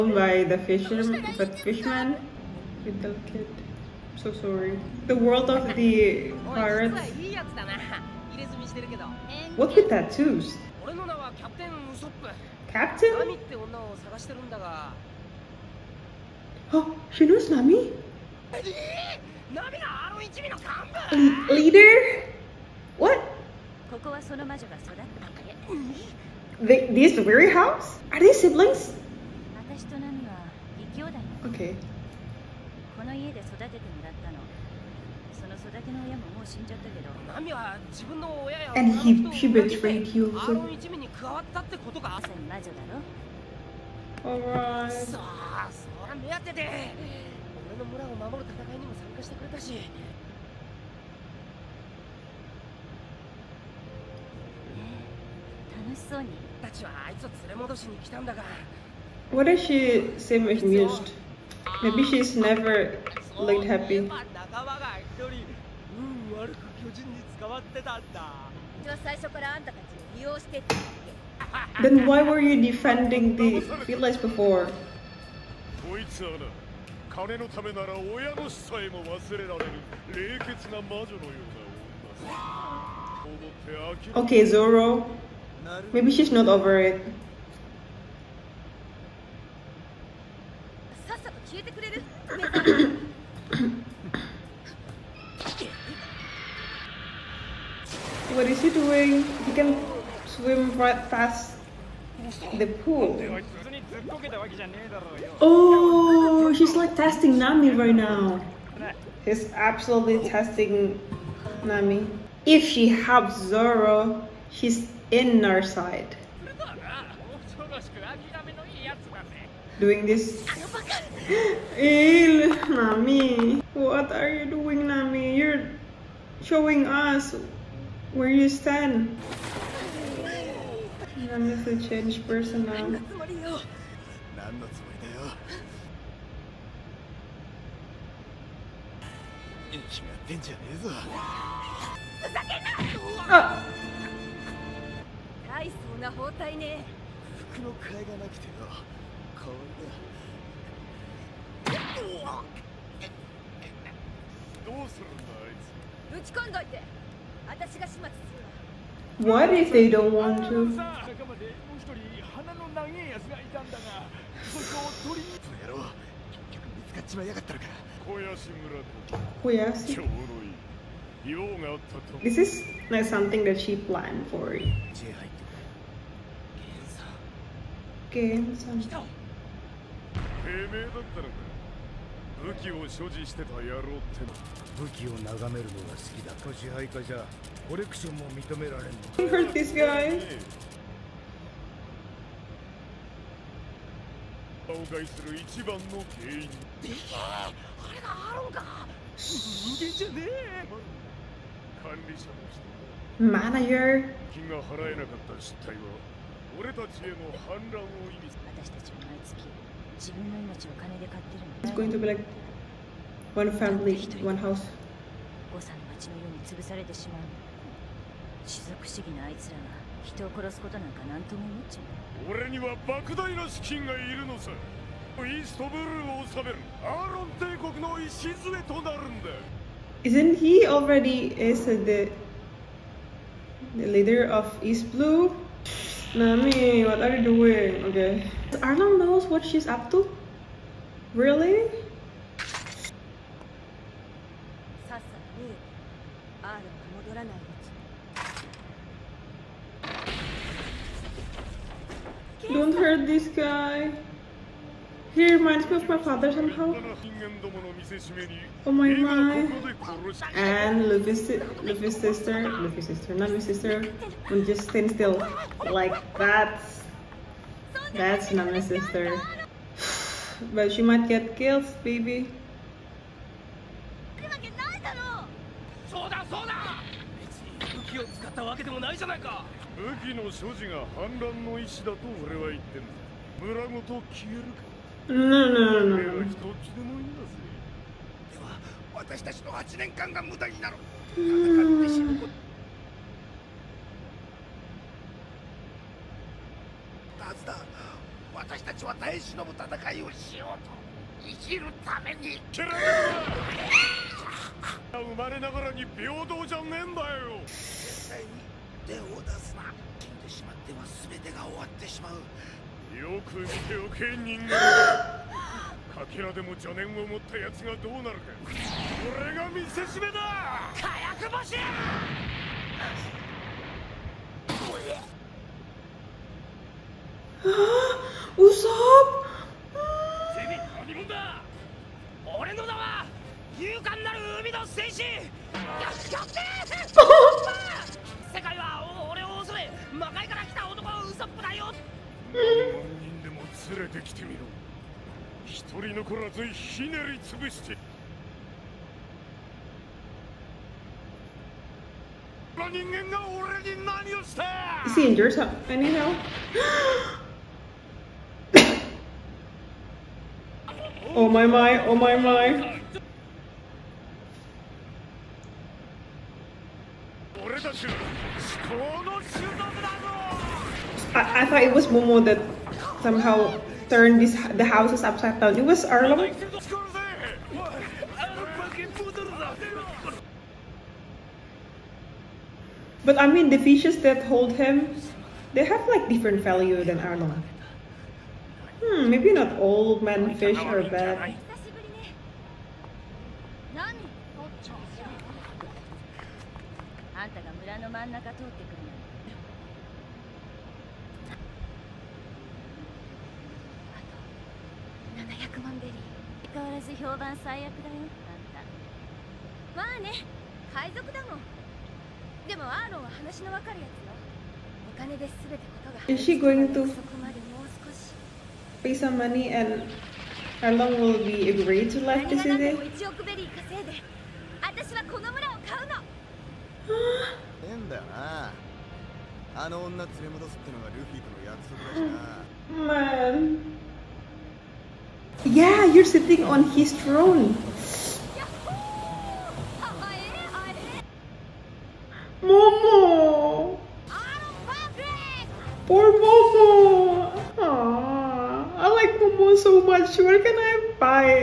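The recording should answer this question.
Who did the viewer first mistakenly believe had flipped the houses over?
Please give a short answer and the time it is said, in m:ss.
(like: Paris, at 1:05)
Momo, at 6:11.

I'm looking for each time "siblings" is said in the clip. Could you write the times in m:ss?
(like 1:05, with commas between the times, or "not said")
0:28.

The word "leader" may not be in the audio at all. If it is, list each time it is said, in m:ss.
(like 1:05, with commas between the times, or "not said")
0:21, 3:53.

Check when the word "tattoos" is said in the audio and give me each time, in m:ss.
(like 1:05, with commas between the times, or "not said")
0:09.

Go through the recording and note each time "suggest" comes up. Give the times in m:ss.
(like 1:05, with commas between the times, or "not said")
not said.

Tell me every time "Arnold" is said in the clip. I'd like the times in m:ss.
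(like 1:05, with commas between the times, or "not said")
3:58.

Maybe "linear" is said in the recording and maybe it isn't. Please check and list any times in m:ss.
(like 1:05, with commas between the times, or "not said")
not said.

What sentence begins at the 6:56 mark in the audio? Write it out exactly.
Is she going to pay some money and how long will we agree to live this day?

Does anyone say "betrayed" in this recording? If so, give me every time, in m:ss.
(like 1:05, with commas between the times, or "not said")
0:39.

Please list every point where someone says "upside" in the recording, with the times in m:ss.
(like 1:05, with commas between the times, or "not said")
6:15.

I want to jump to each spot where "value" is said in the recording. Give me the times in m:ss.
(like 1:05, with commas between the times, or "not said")
6:26.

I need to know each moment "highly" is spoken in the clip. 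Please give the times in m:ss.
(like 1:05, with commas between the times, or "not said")
not said.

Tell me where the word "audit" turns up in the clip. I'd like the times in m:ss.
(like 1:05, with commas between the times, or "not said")
not said.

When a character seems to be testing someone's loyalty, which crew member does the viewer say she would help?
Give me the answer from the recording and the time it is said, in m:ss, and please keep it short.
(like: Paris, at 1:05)
Zoro, at 1:53.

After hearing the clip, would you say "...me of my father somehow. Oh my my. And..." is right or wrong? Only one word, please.
right.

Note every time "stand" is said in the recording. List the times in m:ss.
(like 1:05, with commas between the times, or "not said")
2:08, 4:24.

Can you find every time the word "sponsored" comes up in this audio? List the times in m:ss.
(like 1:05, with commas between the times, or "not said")
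not said.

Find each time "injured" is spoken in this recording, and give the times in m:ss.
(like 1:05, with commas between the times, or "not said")
5:55.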